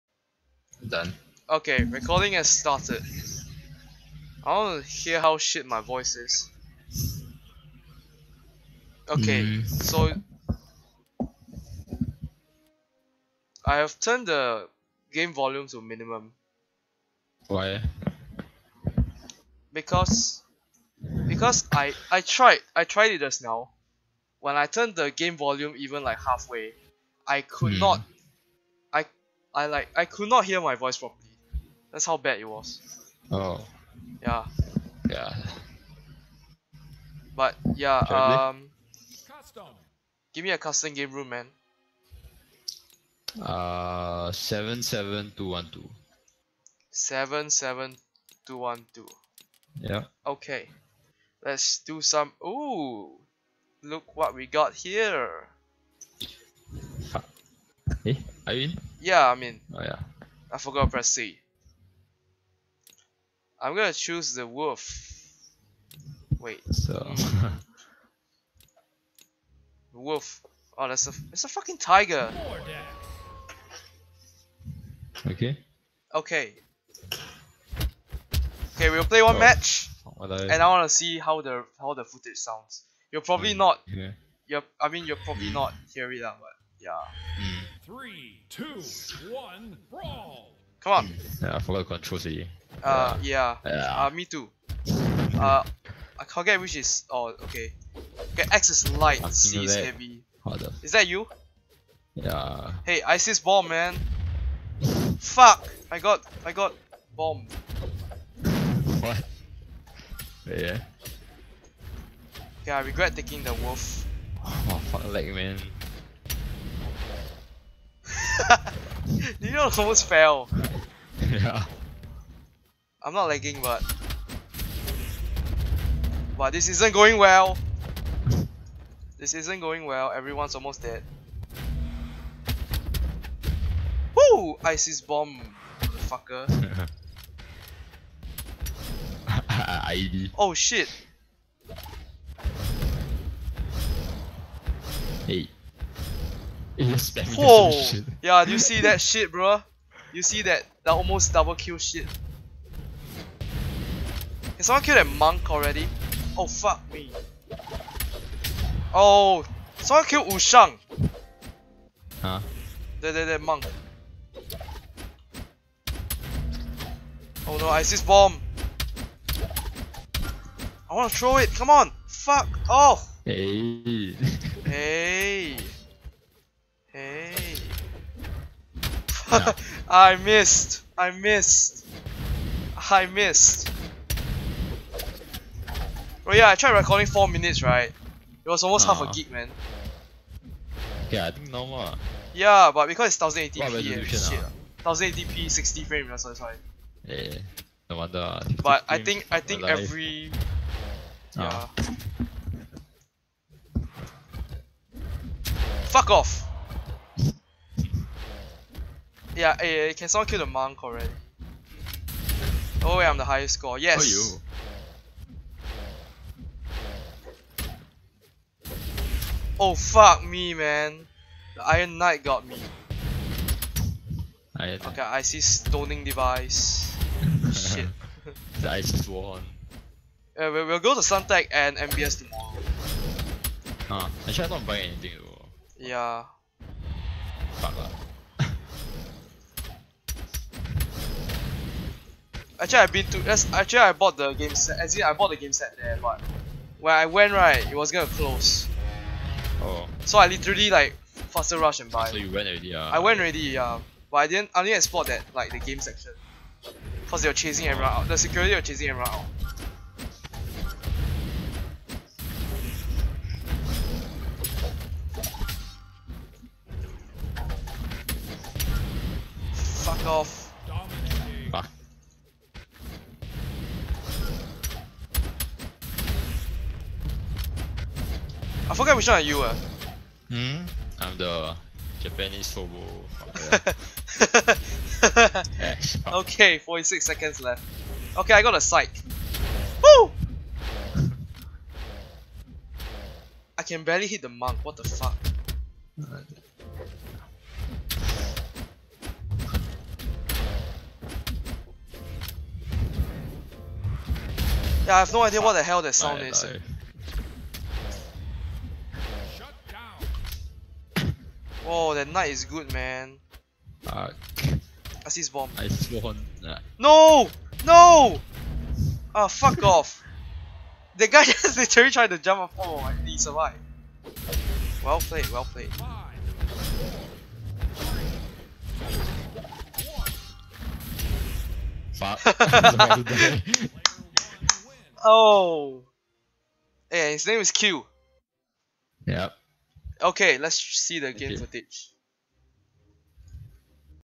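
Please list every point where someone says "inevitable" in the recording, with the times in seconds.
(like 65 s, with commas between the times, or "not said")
not said.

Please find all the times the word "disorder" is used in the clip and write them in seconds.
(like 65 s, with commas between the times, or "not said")
not said.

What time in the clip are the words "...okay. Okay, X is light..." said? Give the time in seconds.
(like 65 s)
97 s.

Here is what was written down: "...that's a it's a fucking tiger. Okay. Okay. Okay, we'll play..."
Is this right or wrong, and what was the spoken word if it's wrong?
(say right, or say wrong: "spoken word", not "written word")
right.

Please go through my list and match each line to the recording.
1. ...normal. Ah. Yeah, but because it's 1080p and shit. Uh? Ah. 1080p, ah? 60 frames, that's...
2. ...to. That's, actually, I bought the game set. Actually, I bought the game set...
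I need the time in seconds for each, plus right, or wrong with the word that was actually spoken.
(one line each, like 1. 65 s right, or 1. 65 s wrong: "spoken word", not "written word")
1. 191 s right
2. 243 s right.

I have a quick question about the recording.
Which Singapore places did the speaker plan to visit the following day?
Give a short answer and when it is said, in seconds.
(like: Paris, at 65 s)
Suntec and MBS, at 231 s.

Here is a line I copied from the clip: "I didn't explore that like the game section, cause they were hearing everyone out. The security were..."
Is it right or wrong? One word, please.
wrong.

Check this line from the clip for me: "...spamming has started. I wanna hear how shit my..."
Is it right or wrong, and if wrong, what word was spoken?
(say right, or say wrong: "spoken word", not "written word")
wrong: "recording", not "spamming".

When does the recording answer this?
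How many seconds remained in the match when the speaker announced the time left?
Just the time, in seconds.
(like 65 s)
286 s.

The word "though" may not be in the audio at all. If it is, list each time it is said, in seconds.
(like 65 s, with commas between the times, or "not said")
235 s.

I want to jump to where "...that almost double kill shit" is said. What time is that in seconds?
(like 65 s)
150 s.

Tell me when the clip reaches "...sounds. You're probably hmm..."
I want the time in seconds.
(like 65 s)
82 s.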